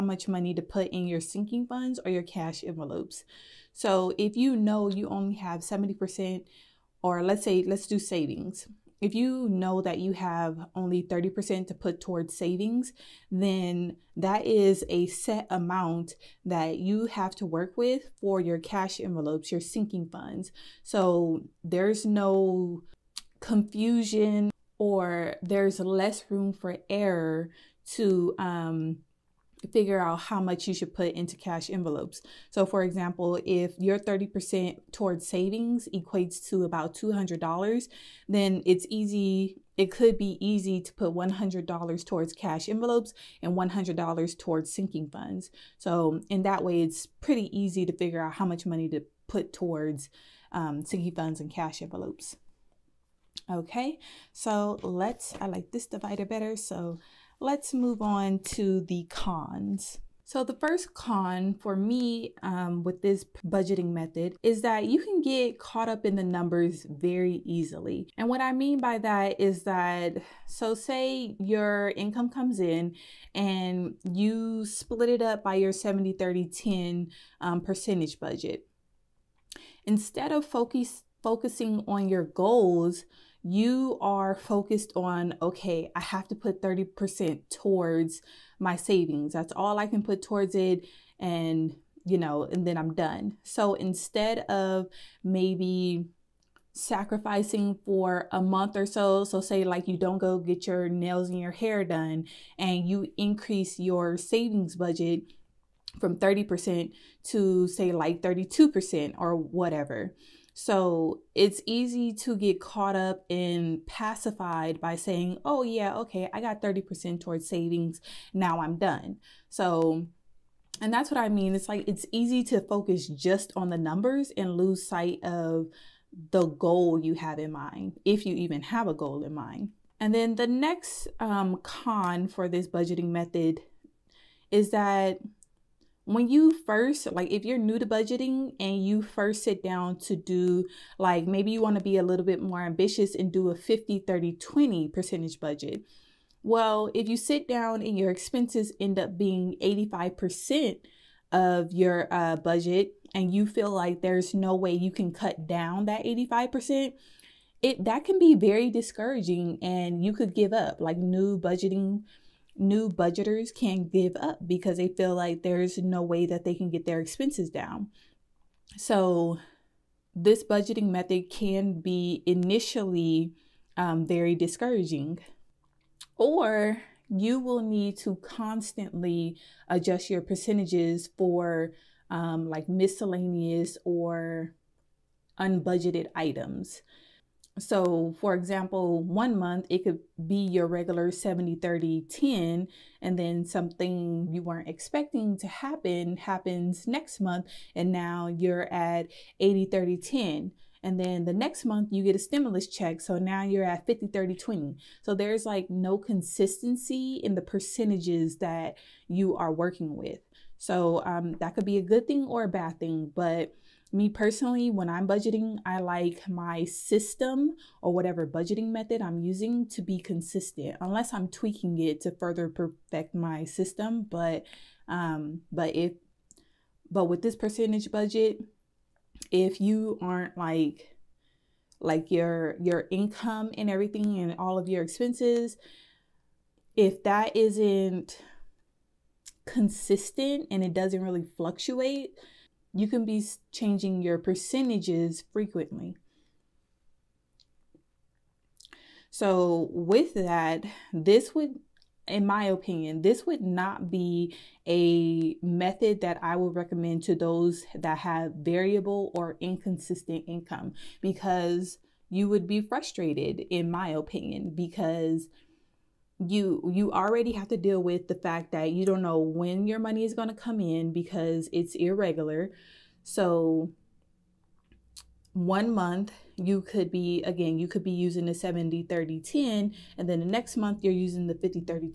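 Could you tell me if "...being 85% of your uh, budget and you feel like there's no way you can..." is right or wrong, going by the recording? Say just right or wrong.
right.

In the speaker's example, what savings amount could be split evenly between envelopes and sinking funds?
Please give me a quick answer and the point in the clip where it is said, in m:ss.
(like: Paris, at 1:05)
$200, at 0:36.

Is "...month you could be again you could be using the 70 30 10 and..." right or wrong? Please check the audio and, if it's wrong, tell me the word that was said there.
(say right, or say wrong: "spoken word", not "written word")
right.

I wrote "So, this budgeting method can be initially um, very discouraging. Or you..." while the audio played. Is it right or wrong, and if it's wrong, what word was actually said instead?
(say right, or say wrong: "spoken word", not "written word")
right.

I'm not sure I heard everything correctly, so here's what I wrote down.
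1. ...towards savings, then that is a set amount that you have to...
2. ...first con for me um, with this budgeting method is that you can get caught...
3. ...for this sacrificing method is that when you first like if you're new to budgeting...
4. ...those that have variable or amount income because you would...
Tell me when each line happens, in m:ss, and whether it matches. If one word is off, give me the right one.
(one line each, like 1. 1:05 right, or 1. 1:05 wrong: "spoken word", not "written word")
1. 0:11 right
2. 1:00 right
3. 2:12 wrong: "budgeting", not "sacrificing"
4. 4:17 wrong: "inconsistent", not "amount".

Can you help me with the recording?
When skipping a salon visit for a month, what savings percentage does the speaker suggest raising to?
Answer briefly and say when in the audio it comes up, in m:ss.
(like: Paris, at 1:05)
32%, at 1:48.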